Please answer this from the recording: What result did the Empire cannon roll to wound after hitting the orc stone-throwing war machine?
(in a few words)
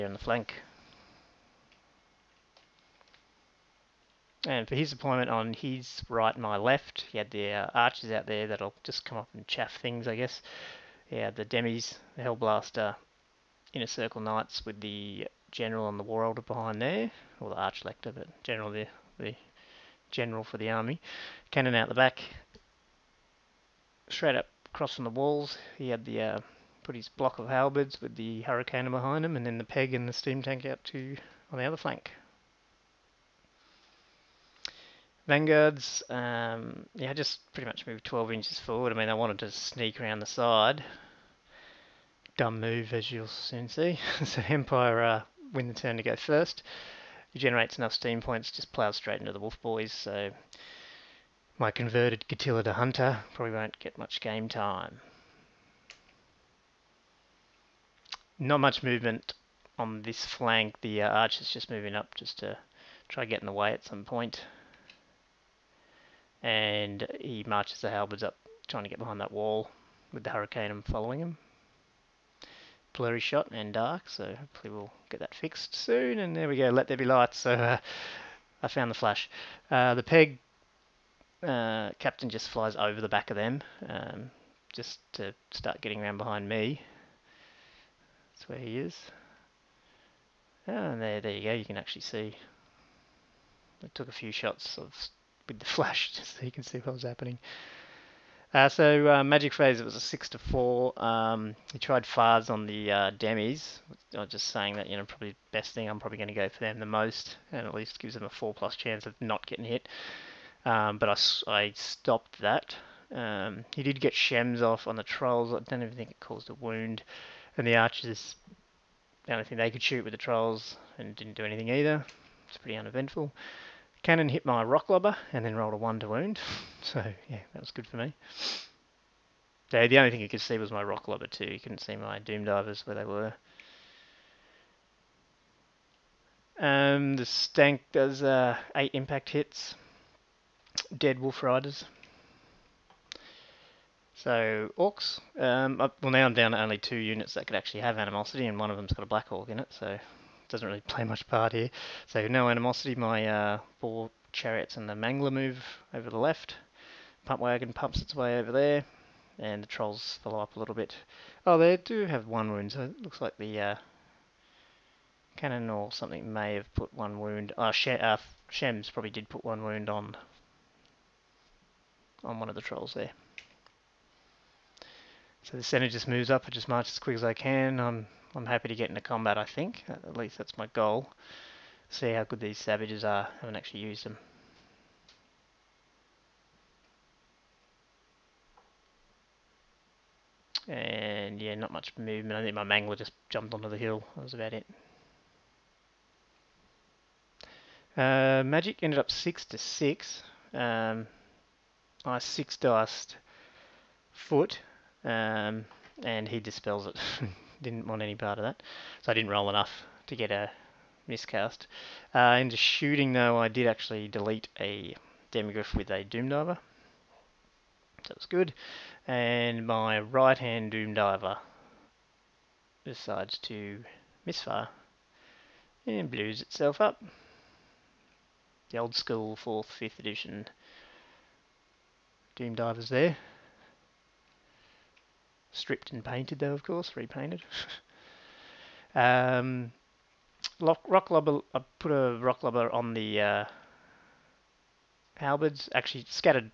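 1.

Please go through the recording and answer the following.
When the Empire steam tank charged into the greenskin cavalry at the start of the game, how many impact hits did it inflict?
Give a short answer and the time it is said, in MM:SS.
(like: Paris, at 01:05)
8, at 02:18.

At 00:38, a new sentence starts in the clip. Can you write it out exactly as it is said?
I mean, I wanted to sneak around the side.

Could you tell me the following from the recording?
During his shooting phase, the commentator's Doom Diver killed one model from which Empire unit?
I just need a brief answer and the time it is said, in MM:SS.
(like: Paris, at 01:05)
Demigryph, at 03:35.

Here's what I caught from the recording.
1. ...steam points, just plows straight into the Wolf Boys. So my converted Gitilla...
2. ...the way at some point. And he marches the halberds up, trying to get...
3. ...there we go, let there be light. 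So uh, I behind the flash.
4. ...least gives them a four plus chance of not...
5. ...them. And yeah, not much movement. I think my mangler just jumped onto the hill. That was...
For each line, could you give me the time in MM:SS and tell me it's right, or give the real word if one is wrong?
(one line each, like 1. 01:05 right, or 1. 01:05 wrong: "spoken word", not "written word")
1. 00:47 right
2. 01:03 right
3. 01:16 wrong: "found", not "behind"
4. 01:47 right
5. 03:04 right.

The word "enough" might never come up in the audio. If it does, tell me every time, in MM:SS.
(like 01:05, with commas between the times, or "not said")
00:47, 03:29.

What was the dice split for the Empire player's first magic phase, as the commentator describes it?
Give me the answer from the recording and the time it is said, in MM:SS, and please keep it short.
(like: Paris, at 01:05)
6 to 4, at 01:39.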